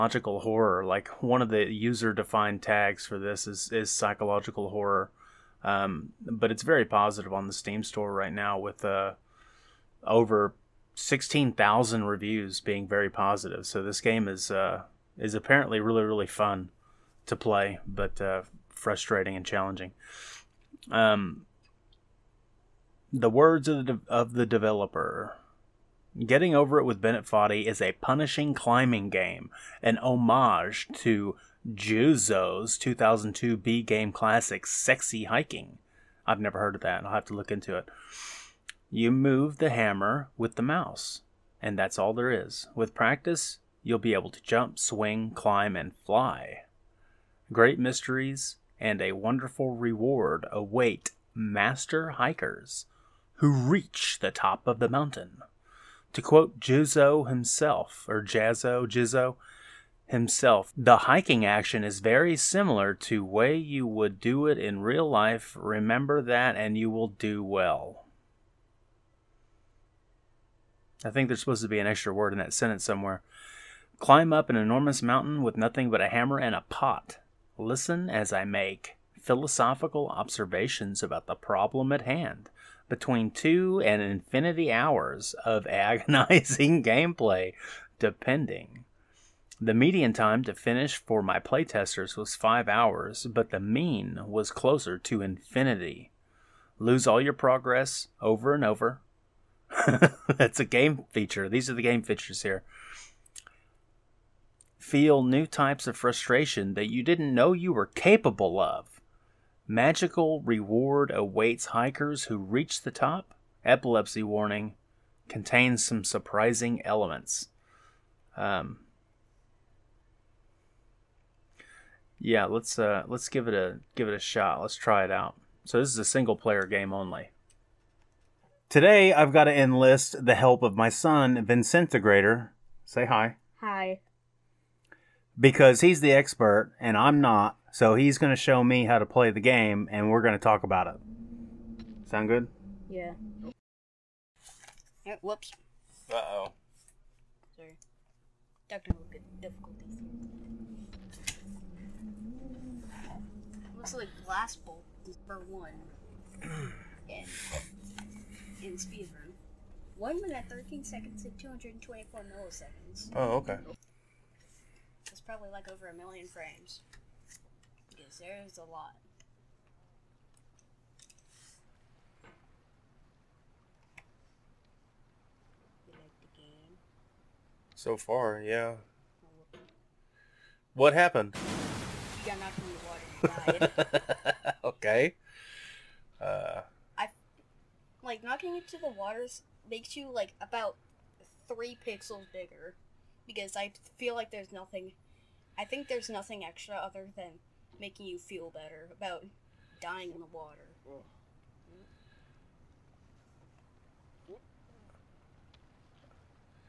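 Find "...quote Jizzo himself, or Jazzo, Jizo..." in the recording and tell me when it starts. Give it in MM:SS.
00:56.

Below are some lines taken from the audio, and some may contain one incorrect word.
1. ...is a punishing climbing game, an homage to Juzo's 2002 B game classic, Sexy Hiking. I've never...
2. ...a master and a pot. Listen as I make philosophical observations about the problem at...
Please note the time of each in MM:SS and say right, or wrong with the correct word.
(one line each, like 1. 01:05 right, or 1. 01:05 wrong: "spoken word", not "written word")
1. 00:27 right
2. 01:15 wrong: "hammer", not "master".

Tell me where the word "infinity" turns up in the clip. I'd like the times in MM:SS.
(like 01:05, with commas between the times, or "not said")
01:23, 01:35.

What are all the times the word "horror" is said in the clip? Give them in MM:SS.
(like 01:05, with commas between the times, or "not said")
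00:00, 00:04.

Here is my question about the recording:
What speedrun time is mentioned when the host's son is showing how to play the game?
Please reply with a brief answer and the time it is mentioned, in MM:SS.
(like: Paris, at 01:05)
1 minute 13 seconds 224 milliseconds, at 02:39.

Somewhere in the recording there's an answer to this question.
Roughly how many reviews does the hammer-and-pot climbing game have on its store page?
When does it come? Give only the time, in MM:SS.
00:10.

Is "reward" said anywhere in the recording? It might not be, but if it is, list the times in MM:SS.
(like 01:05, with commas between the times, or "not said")
00:49, 01:50.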